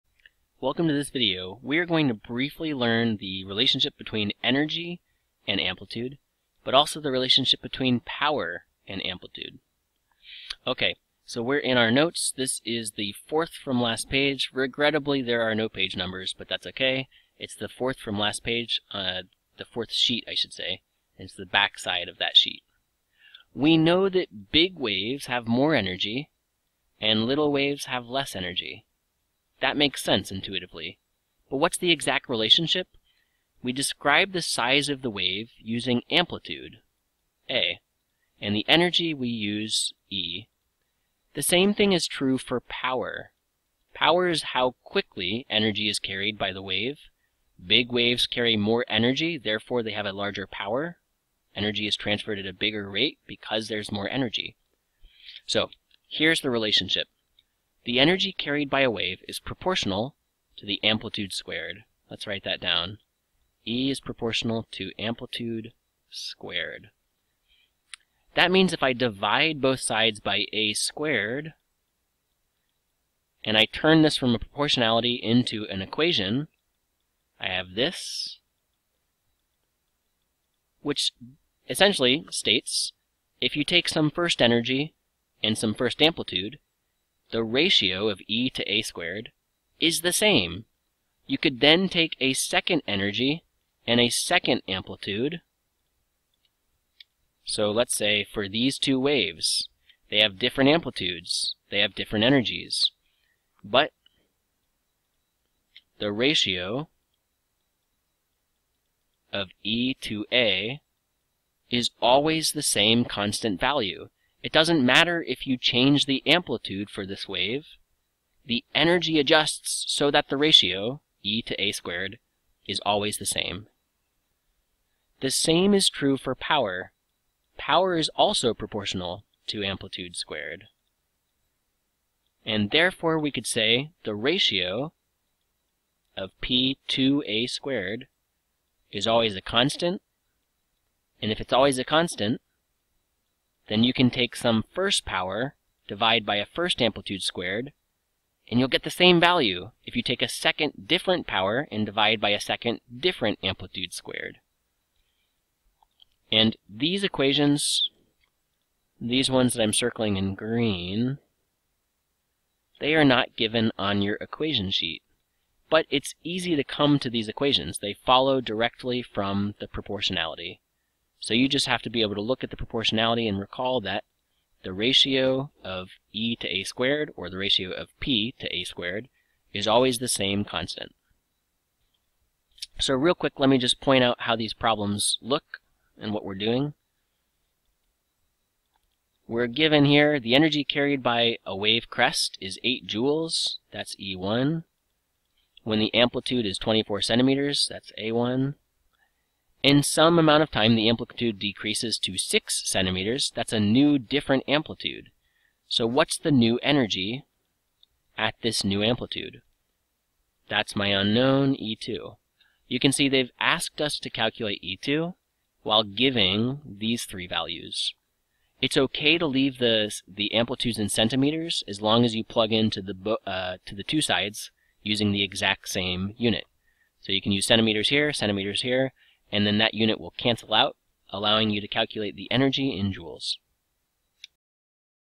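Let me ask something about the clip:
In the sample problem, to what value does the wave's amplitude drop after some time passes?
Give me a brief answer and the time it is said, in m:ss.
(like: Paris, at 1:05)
6 centimeters, at 3:22.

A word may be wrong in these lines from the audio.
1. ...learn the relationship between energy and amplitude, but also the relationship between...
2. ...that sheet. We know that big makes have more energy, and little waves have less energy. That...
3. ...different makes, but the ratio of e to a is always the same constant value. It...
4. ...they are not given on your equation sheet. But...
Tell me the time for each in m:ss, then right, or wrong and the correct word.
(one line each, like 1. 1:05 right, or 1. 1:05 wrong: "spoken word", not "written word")
1. 0:02 right
2. 0:22 wrong: "waves", not "makes"
3. 1:41 wrong: "energies", not "makes"
4. 2:42 right.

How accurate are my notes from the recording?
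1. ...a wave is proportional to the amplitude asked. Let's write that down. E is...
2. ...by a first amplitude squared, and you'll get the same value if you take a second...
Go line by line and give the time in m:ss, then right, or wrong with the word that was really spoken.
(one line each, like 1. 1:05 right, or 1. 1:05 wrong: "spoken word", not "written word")
1. 0:58 wrong: "squared", not "asked"
2. 2:26 right.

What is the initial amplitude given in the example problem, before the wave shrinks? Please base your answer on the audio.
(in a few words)
24 centimeters.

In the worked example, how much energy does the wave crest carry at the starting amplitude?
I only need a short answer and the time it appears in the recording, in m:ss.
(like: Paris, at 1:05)
8 joules, at 3:12.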